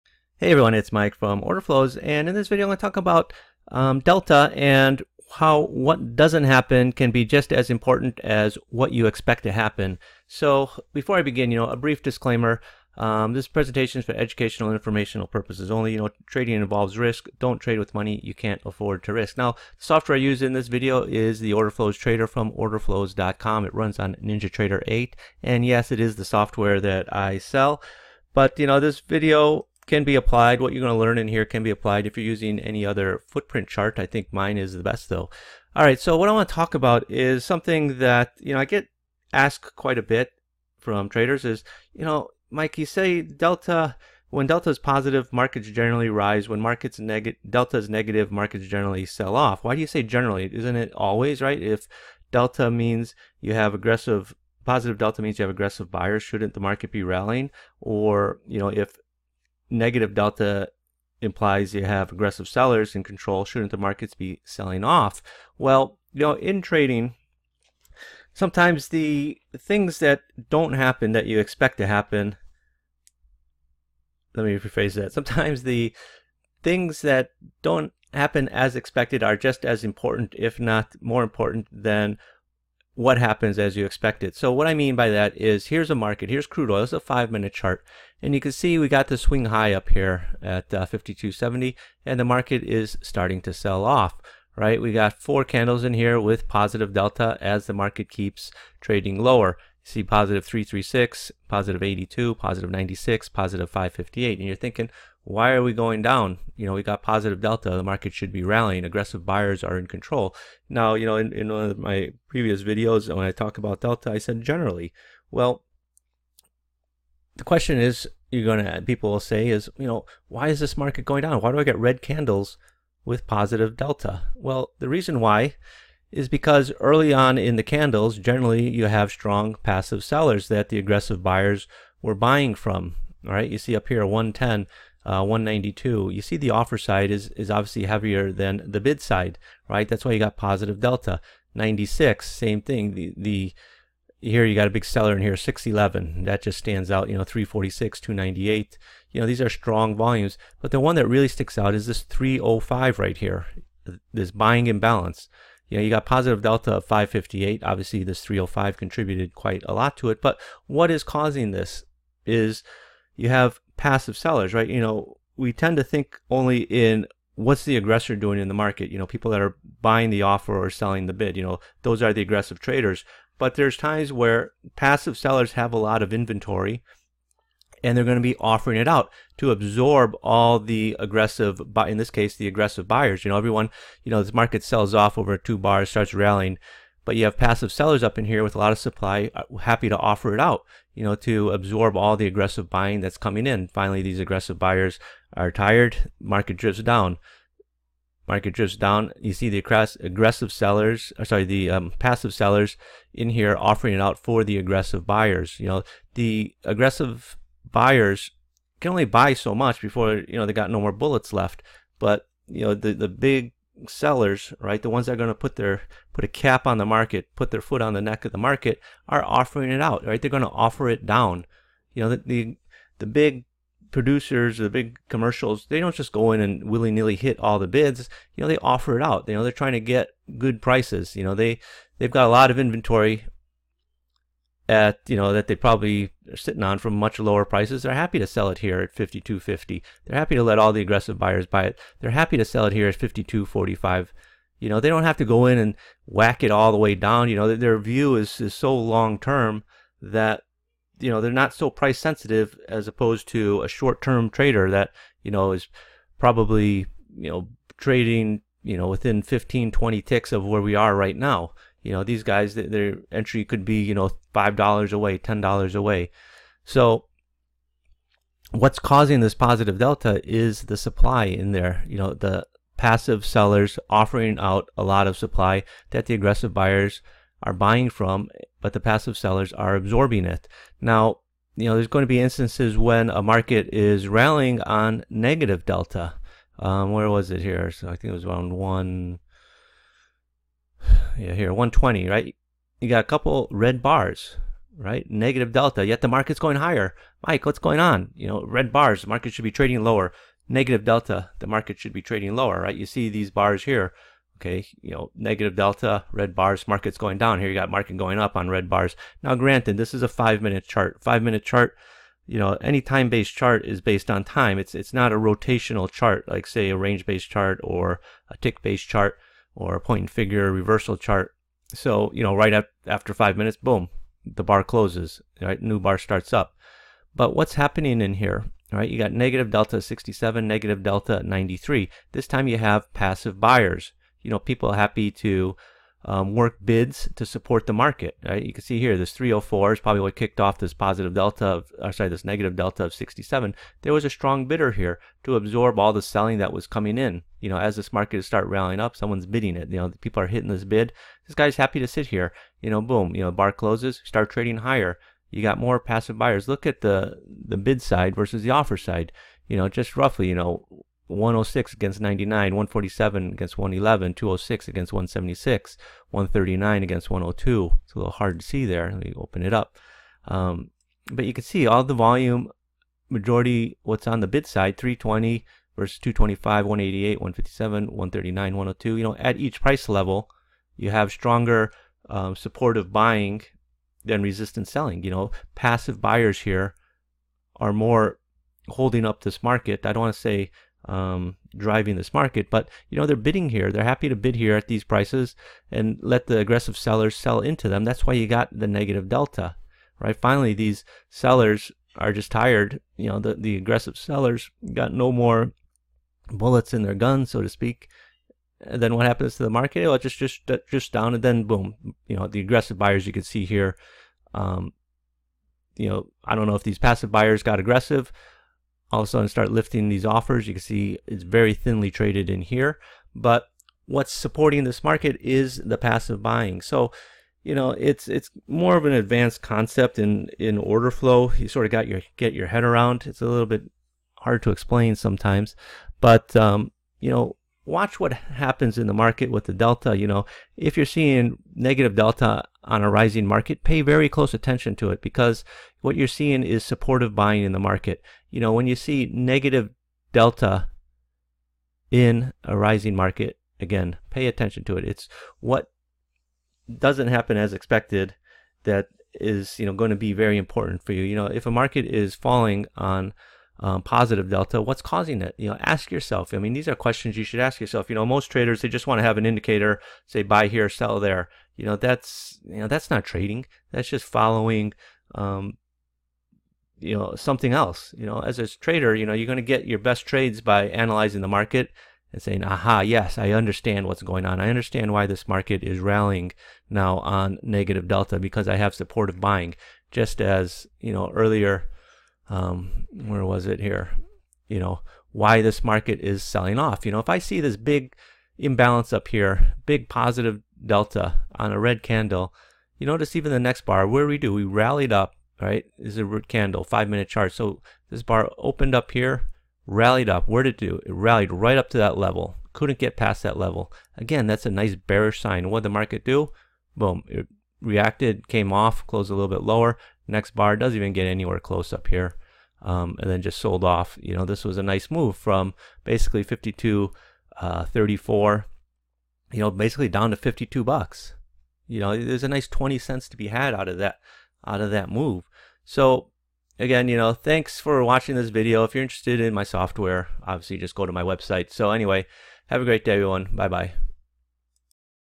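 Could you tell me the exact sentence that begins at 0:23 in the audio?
It runs on NinjaTrader 8, and yes, it is the software that I sell.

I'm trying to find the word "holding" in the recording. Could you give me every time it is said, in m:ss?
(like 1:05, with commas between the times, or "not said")
6:28.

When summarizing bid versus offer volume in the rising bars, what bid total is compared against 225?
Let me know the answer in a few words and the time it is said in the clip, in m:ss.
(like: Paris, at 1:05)
320, at 6:14.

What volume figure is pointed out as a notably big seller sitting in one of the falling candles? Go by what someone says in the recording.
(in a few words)
611.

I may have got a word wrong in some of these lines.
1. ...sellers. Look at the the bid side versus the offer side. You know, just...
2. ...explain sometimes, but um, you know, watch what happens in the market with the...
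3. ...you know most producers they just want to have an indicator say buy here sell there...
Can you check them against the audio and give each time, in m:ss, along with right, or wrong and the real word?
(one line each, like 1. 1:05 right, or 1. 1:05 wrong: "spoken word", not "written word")
1. 5:56 wrong: "buyers", not "sellers"
2. 7:14 right
3. 7:47 wrong: "traders", not "producers".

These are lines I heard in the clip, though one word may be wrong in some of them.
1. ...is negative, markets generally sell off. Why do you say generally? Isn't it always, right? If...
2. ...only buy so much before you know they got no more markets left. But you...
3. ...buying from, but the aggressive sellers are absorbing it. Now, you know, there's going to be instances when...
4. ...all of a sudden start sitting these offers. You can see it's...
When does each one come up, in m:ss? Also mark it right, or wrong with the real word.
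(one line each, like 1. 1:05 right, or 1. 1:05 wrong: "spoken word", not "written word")
1. 0:47 right
2. 3:28 wrong: "bullets", not "markets"
3. 4:37 wrong: "passive", not "aggressive"
4. 6:58 wrong: "lifting", not "sitting".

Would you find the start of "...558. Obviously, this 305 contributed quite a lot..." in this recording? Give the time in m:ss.
2:36.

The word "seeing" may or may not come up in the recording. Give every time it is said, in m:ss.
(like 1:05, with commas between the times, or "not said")
7:20, 7:26.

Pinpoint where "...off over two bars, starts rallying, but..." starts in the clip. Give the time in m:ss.
3:04.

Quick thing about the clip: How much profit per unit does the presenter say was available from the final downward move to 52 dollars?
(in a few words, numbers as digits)
20 cents.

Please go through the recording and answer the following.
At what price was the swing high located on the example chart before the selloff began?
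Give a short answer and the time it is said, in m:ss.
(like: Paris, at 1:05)
52.70, at 1:30.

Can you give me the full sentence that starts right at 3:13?
Finally, these aggressive buyers are tired, market drifts down.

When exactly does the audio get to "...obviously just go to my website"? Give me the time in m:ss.
9:00.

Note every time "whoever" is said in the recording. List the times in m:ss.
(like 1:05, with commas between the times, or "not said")
not said.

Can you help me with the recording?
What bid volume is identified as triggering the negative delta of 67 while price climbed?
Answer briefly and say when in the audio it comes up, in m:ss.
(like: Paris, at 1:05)
304, at 5:39.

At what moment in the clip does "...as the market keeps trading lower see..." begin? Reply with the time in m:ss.
1:37.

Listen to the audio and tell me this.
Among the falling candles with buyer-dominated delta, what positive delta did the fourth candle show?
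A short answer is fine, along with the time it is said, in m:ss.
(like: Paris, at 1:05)
558, at 1:43.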